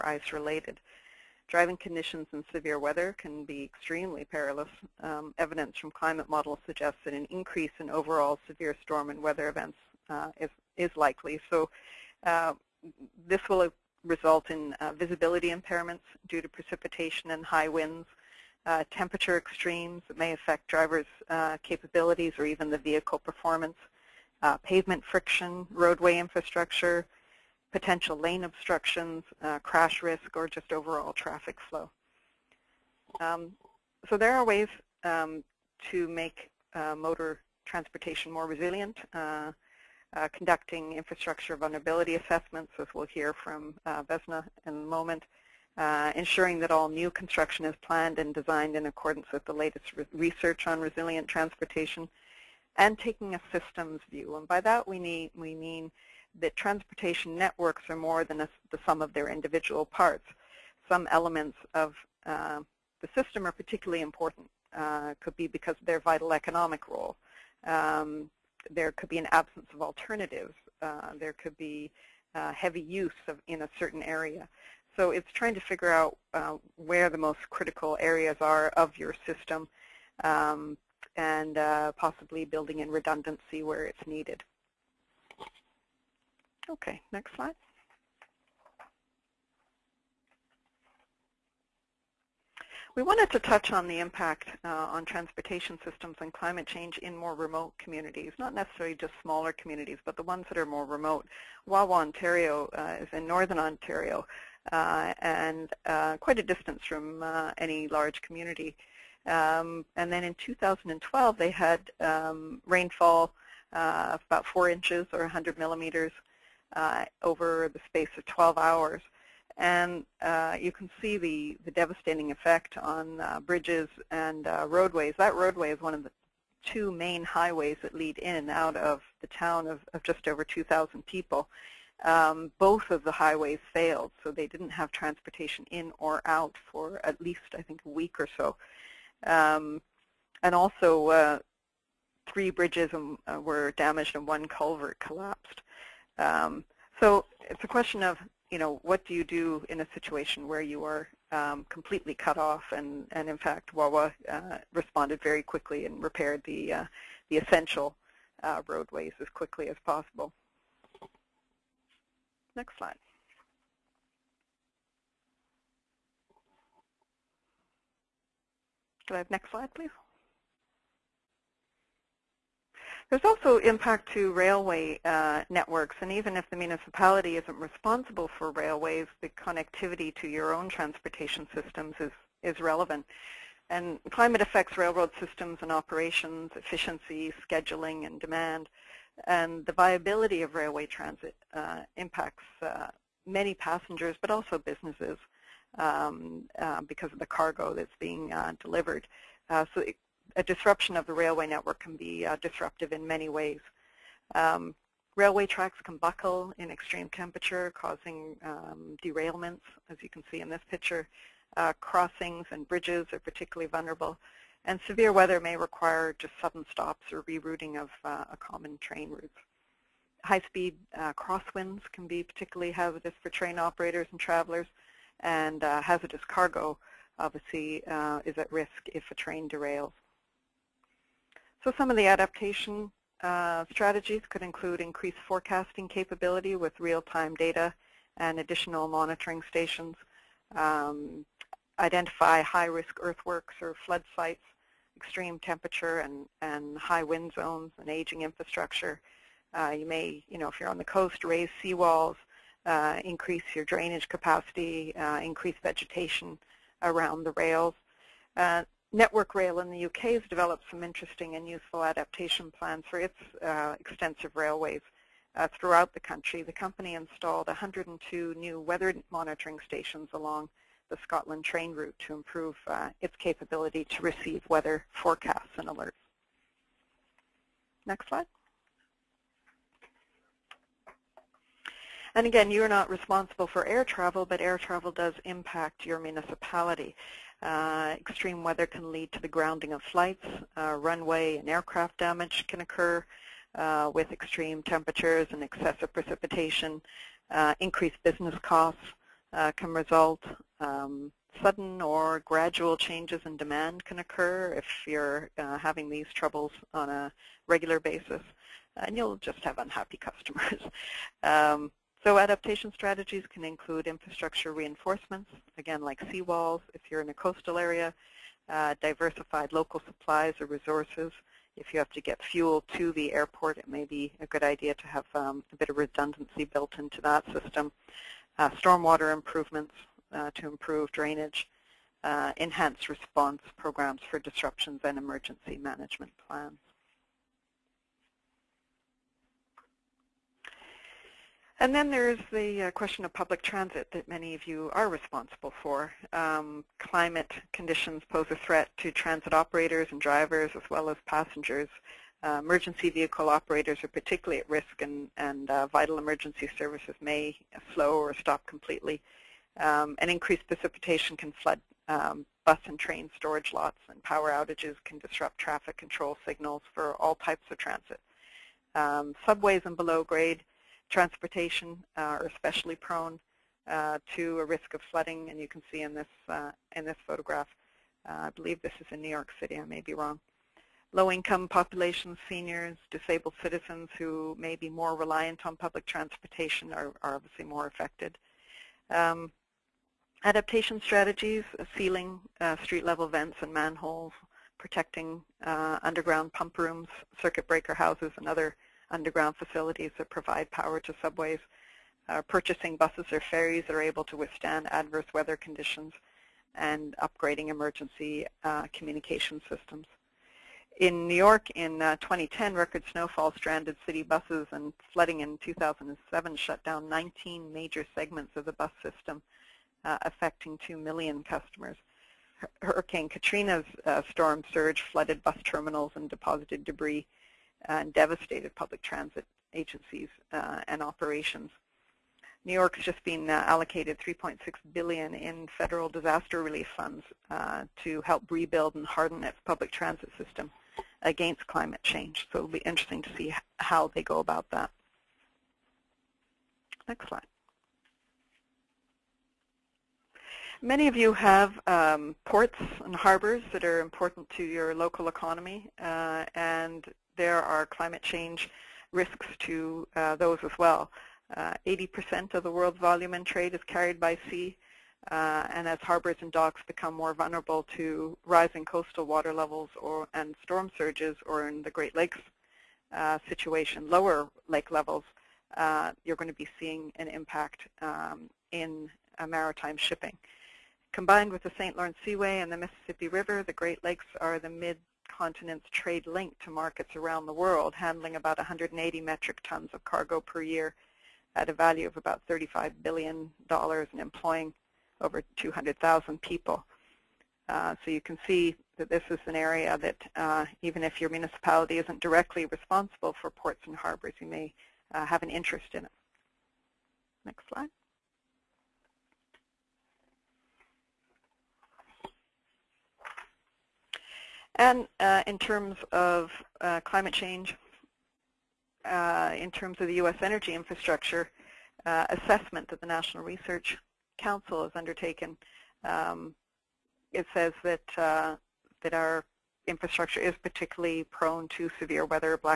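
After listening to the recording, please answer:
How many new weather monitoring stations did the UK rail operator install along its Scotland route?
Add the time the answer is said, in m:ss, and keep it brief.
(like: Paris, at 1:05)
102, at 4:27.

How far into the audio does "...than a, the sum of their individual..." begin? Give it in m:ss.
0:58.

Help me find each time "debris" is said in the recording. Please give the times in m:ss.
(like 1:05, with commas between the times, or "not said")
7:06.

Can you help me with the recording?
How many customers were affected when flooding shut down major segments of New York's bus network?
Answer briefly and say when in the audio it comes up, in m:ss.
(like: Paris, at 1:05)
2 million, at 7:00.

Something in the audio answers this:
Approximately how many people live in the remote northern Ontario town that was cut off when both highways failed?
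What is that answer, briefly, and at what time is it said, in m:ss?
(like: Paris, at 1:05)
2,000, at 2:10.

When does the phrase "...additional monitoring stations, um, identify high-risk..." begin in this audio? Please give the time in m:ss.
3:58.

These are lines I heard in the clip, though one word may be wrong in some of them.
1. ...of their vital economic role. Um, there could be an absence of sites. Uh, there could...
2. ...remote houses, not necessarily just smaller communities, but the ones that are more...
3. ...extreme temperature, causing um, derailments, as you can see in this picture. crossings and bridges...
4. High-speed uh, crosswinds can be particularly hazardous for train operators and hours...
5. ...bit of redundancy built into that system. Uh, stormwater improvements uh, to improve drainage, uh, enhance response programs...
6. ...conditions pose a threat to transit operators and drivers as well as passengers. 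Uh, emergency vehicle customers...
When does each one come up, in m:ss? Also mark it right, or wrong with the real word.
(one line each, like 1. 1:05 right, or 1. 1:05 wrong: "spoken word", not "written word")
1. 1:05 wrong: "alternatives", not "sites"
2. 1:37 wrong: "communities", not "houses"
3. 3:26 right
4. 3:40 wrong: "travelers", not "hours"
5. 5:25 right
6. 5:47 wrong: "operators", not "customers".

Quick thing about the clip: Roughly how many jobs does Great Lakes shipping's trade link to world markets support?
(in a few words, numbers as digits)
over 200,000.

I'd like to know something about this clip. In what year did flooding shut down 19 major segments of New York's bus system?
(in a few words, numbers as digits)
2007.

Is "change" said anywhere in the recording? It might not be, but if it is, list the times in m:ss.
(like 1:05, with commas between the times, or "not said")
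1:36, 5:02, 7:21, 7:38, 8:37.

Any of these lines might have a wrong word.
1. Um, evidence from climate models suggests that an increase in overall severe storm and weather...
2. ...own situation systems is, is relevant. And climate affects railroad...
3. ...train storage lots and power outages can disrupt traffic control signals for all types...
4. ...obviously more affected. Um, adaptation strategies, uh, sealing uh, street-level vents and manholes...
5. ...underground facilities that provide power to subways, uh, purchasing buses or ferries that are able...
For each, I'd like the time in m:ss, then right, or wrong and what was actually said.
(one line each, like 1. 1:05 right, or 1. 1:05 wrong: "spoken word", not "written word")
1. 0:05 right
2. 3:00 wrong: "transportation", not "situation"
3. 6:02 right
4. 6:27 right
5. 6:38 right.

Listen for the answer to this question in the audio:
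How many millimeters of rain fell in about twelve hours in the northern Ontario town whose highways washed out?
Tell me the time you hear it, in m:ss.
1:55.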